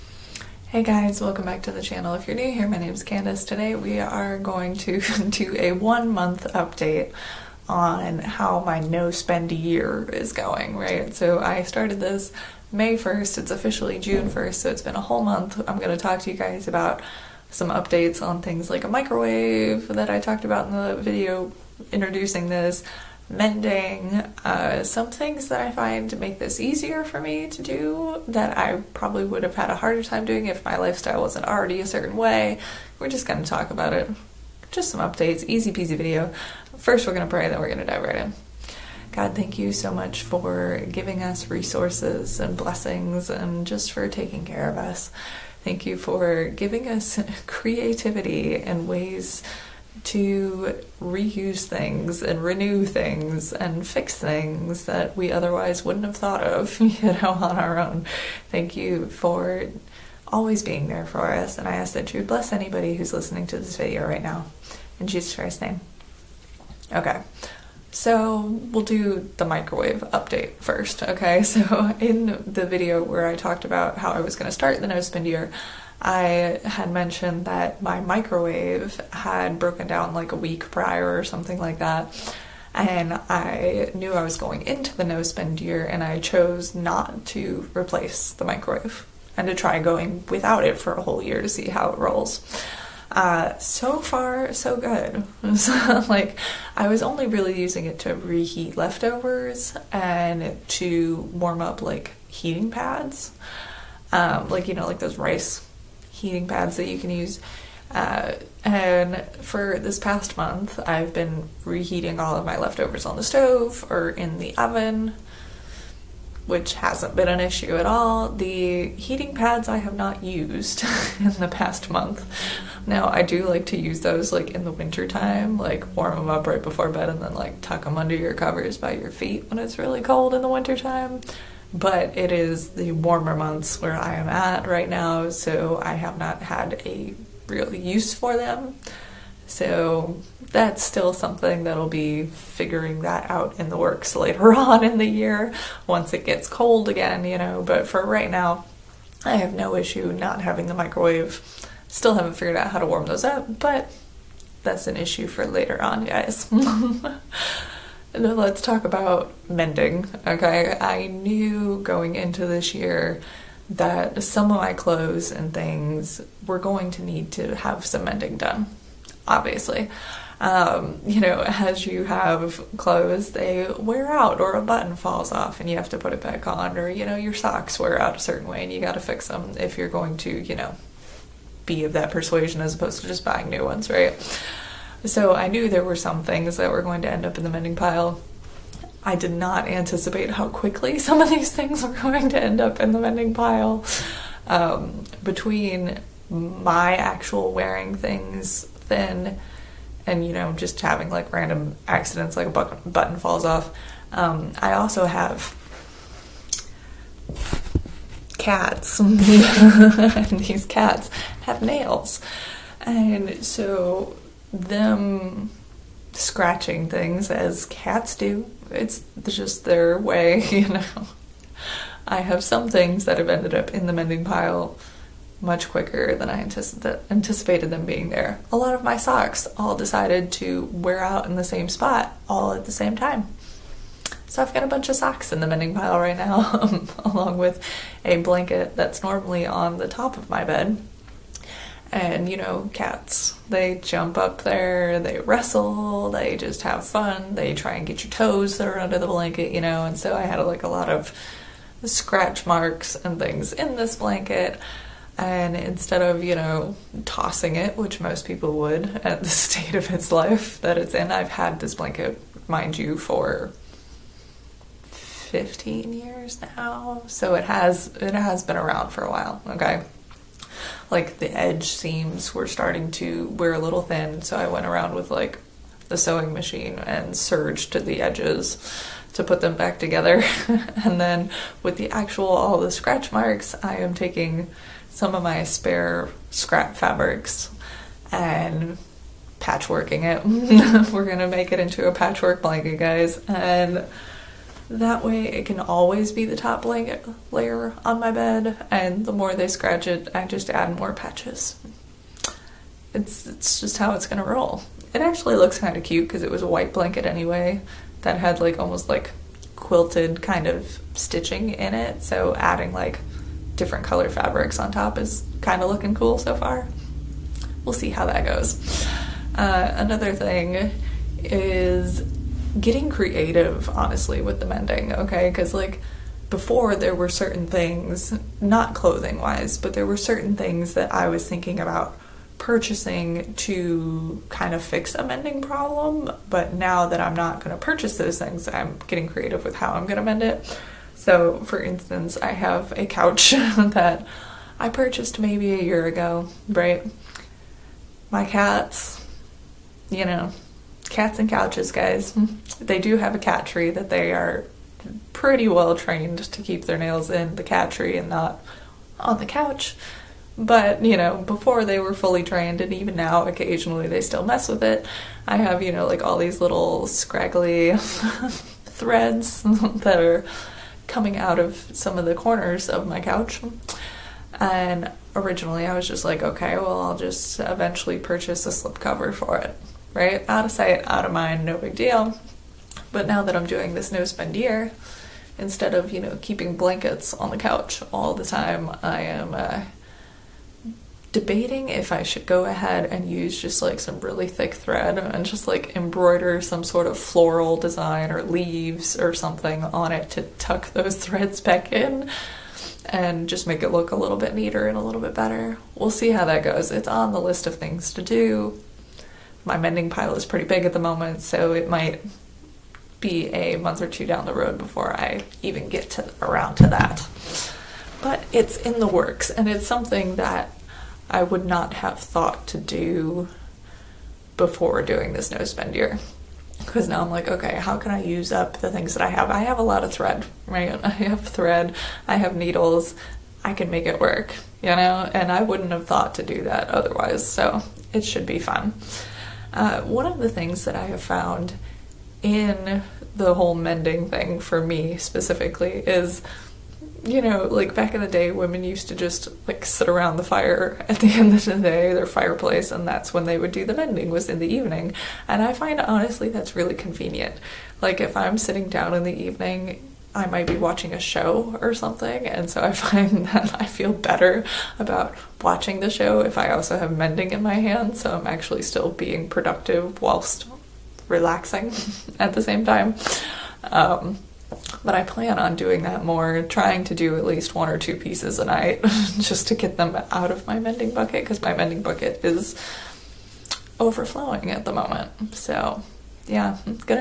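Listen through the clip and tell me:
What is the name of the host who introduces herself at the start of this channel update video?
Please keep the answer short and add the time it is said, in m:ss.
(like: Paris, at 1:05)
Candice, at 0:03.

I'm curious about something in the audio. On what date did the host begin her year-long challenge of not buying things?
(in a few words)
May 1st.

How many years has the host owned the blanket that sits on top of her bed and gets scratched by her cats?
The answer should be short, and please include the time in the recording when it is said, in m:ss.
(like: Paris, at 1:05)
15, at 4:24.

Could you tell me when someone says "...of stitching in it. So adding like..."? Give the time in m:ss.
5:10.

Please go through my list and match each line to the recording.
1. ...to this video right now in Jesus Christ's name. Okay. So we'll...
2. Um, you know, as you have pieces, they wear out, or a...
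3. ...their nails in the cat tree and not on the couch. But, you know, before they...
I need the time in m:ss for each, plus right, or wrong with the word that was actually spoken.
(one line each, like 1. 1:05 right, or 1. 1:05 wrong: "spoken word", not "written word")
1. 1:03 right
2. 2:50 wrong: "clothes", not "pieces"
3. 5:56 right.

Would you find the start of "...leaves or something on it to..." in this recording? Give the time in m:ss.
6:38.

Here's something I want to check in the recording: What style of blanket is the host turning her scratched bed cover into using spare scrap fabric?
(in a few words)
Patchwork blanket.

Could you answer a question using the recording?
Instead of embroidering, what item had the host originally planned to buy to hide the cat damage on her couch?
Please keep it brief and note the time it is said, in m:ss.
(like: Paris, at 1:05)
A slipcover, at 6:18.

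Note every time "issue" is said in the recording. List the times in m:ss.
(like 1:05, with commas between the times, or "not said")
1:57, 2:29, 2:34.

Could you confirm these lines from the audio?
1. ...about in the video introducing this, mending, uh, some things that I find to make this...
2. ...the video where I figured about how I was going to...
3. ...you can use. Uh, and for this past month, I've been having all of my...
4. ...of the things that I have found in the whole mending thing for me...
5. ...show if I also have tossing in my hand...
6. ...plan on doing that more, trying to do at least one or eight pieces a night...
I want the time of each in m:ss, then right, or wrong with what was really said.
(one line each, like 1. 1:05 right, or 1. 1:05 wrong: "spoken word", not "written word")
1. 0:20 right
2. 1:12 wrong: "talked", not "figured"
3. 1:46 wrong: "reheating", not "having"
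4. 7:20 right
5. 7:45 wrong: "mending", not "tossing"
6. 7:55 wrong: "two", not "eight".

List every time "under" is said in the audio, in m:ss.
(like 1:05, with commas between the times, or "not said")
2:07, 4:08.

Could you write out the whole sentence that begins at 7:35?
And I find honestly that's really convenient.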